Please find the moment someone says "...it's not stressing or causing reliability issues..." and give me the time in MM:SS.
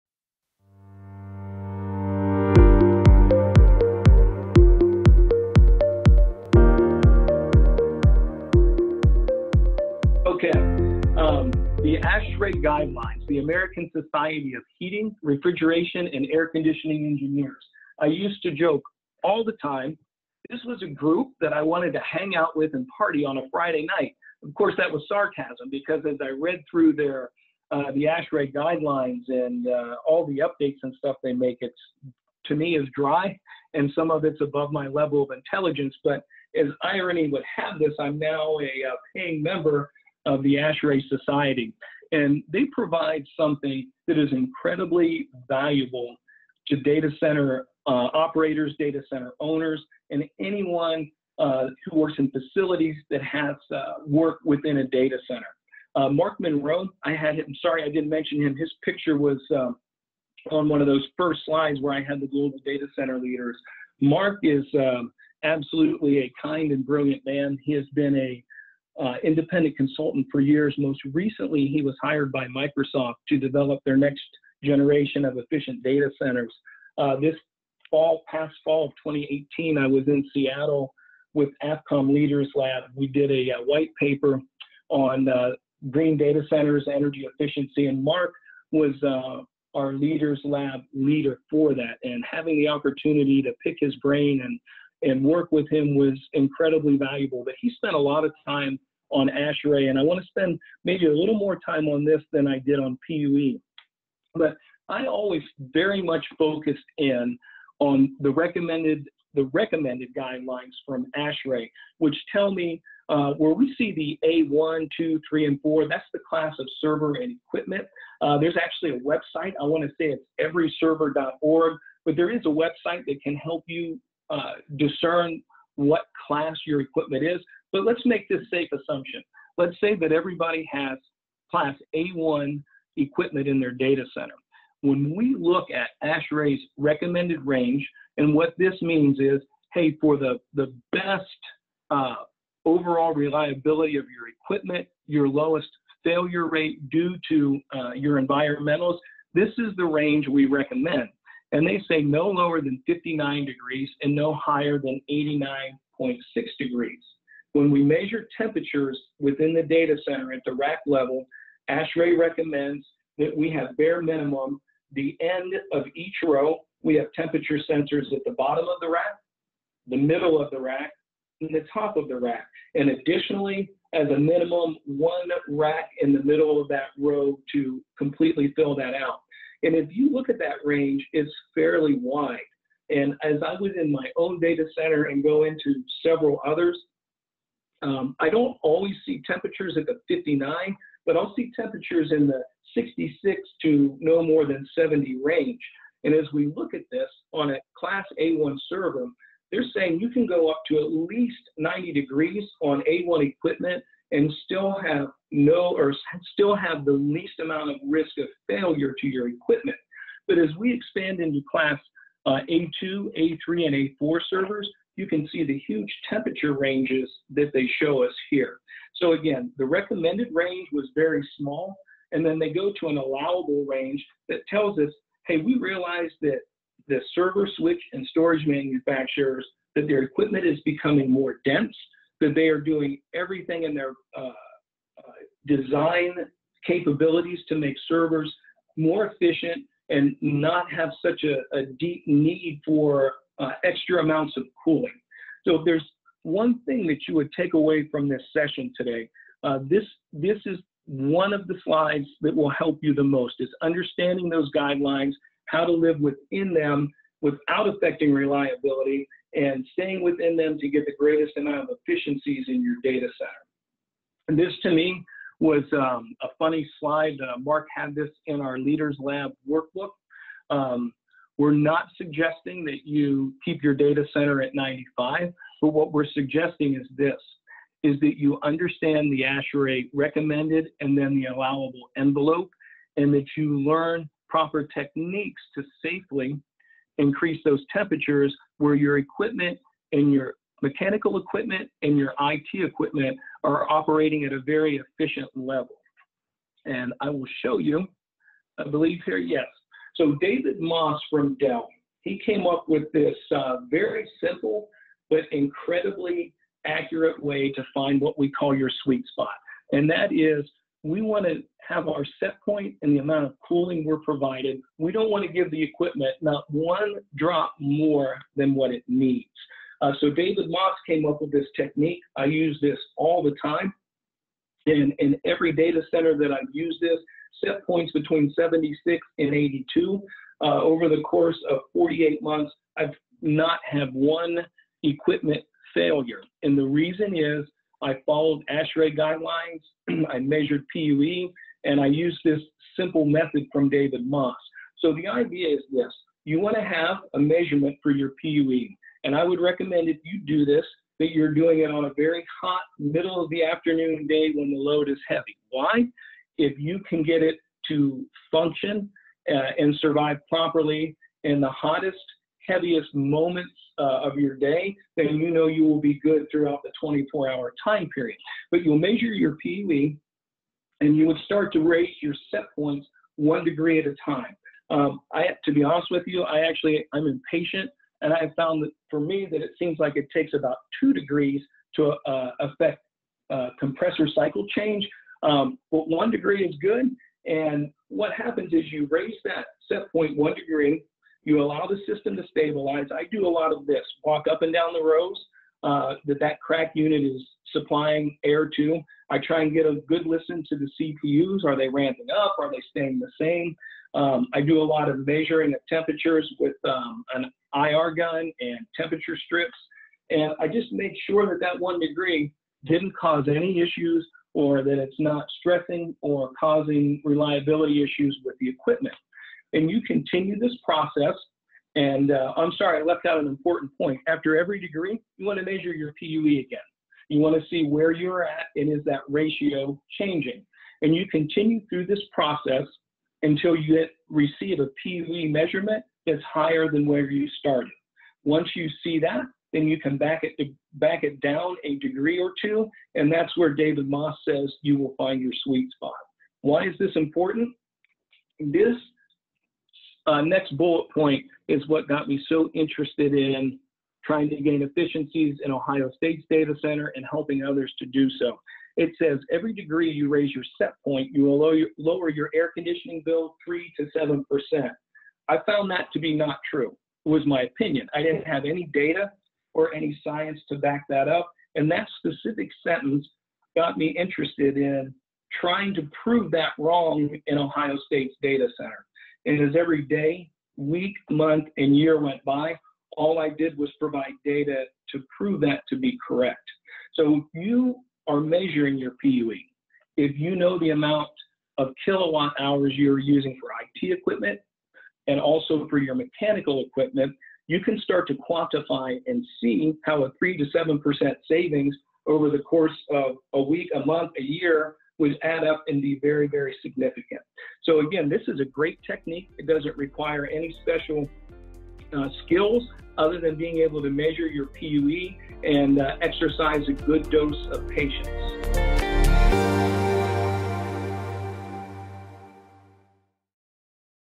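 06:54.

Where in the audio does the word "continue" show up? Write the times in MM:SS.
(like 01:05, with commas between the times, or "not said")
06:59, 07:11.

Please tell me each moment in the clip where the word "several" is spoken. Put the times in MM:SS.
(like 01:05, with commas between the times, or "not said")
03:06.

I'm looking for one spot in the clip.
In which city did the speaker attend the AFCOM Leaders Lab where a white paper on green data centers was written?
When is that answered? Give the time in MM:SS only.
01:20.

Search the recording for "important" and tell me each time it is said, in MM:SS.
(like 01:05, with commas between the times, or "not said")
07:03, 07:26.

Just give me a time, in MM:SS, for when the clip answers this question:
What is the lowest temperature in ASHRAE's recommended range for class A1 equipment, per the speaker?
02:32.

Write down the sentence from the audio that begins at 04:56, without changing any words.
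And I will show you, I believe here, yes.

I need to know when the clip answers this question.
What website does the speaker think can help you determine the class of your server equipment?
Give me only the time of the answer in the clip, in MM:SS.
02:00.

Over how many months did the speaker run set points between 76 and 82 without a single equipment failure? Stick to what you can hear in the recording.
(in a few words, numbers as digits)
48 months.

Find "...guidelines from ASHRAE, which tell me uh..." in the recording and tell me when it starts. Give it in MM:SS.
01:50.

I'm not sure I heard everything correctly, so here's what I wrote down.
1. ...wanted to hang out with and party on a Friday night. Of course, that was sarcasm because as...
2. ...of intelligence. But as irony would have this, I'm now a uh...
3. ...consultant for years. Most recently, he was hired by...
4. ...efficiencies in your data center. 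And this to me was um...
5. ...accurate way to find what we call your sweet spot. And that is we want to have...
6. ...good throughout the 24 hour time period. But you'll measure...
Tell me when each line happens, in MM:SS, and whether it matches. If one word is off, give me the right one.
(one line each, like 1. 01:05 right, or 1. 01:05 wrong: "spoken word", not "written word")
1. 00:21 right
2. 00:35 right
3. 01:09 right
4. 04:21 right
5. 05:06 right
6. 06:05 right.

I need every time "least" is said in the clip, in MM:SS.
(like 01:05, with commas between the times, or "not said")
03:20, 03:26.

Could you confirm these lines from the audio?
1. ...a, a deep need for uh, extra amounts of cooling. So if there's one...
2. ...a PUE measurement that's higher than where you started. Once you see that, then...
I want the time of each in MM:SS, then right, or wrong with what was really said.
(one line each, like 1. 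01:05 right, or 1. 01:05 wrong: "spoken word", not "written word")
1. 04:01 right
2. 07:14 right.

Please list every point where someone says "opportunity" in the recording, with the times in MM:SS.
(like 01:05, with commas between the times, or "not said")
01:32.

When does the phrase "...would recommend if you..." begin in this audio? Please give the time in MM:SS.
05:49.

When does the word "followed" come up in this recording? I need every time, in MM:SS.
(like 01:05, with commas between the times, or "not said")
05:38.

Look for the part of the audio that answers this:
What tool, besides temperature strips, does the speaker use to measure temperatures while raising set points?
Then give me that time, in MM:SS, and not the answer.
06:47.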